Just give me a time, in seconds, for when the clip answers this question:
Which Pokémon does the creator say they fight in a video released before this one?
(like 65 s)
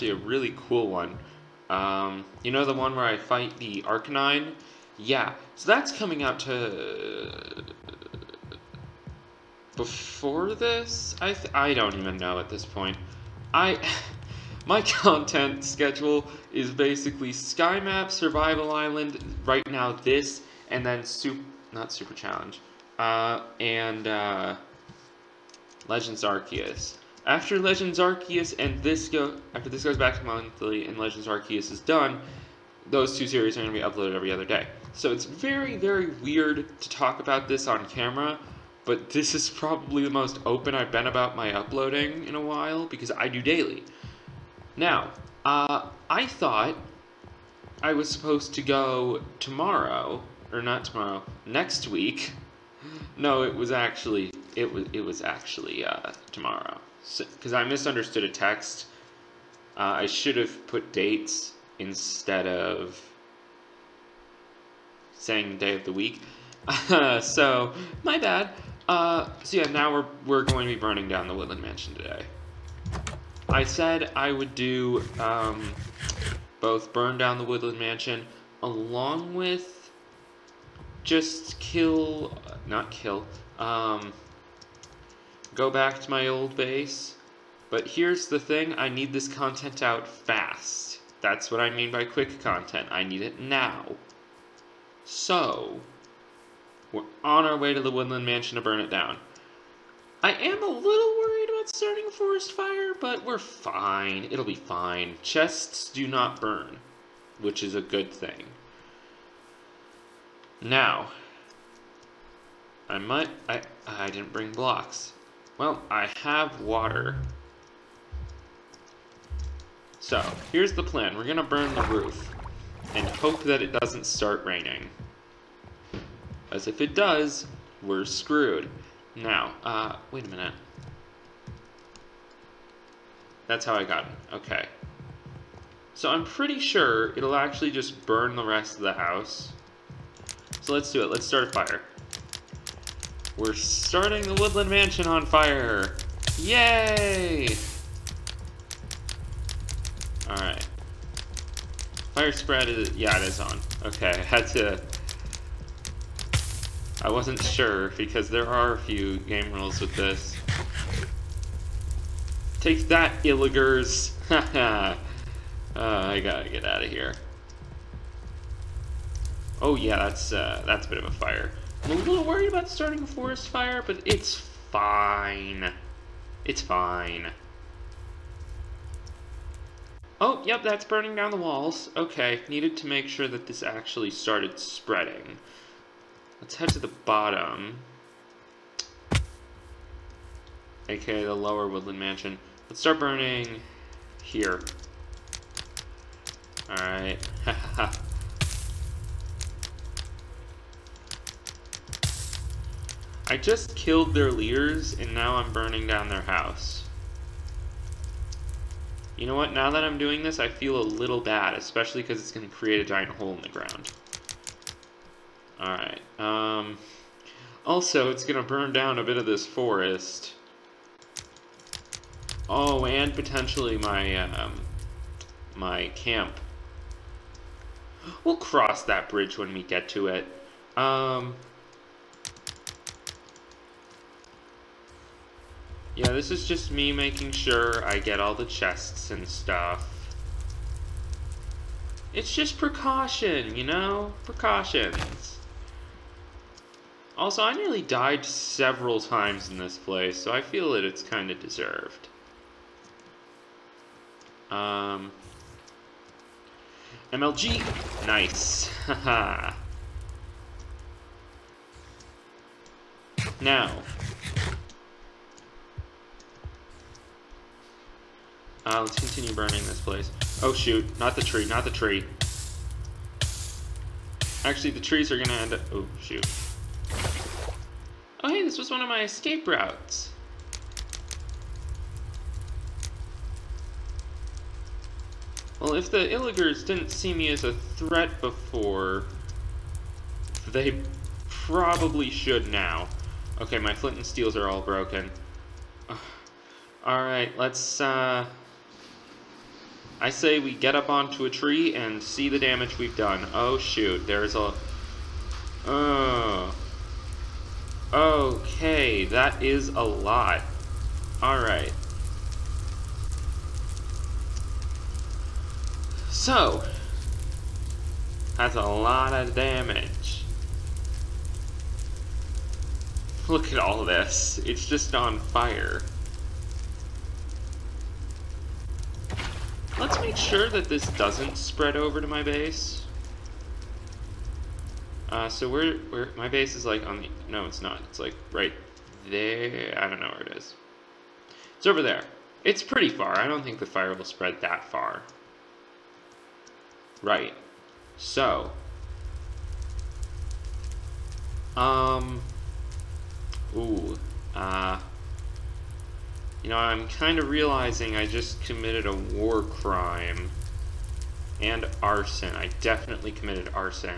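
3 s.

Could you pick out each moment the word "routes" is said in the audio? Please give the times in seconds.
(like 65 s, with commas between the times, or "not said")
279 s.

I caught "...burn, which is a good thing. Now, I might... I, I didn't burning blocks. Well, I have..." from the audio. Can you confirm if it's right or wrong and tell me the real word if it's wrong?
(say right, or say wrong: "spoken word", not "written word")
wrong: "bring", not "burning".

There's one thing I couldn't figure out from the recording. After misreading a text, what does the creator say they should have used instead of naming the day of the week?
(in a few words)
dates.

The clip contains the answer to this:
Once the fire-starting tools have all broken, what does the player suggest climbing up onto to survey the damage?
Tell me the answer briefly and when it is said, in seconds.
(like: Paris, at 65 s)
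a tree, at 301 s.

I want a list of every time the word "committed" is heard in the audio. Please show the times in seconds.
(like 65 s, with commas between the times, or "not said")
358 s, 363 s.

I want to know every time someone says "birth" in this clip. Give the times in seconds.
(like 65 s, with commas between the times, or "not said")
not said.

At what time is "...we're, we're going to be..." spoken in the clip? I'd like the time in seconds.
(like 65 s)
69 s.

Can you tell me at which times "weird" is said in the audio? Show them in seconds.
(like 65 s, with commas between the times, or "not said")
36 s.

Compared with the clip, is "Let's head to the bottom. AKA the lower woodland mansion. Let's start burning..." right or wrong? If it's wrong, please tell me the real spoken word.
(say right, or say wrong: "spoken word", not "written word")
right.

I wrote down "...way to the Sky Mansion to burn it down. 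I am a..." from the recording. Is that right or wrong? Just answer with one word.
wrong.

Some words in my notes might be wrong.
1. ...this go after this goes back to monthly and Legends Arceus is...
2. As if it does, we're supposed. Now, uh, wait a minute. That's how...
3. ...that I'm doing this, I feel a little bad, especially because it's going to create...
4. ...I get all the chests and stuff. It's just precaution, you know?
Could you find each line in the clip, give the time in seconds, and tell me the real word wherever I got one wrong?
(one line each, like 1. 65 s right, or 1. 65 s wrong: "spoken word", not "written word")
1. 28 s right
2. 126 s wrong: "screwed", not "supposed"
3. 209 s right
4. 237 s right.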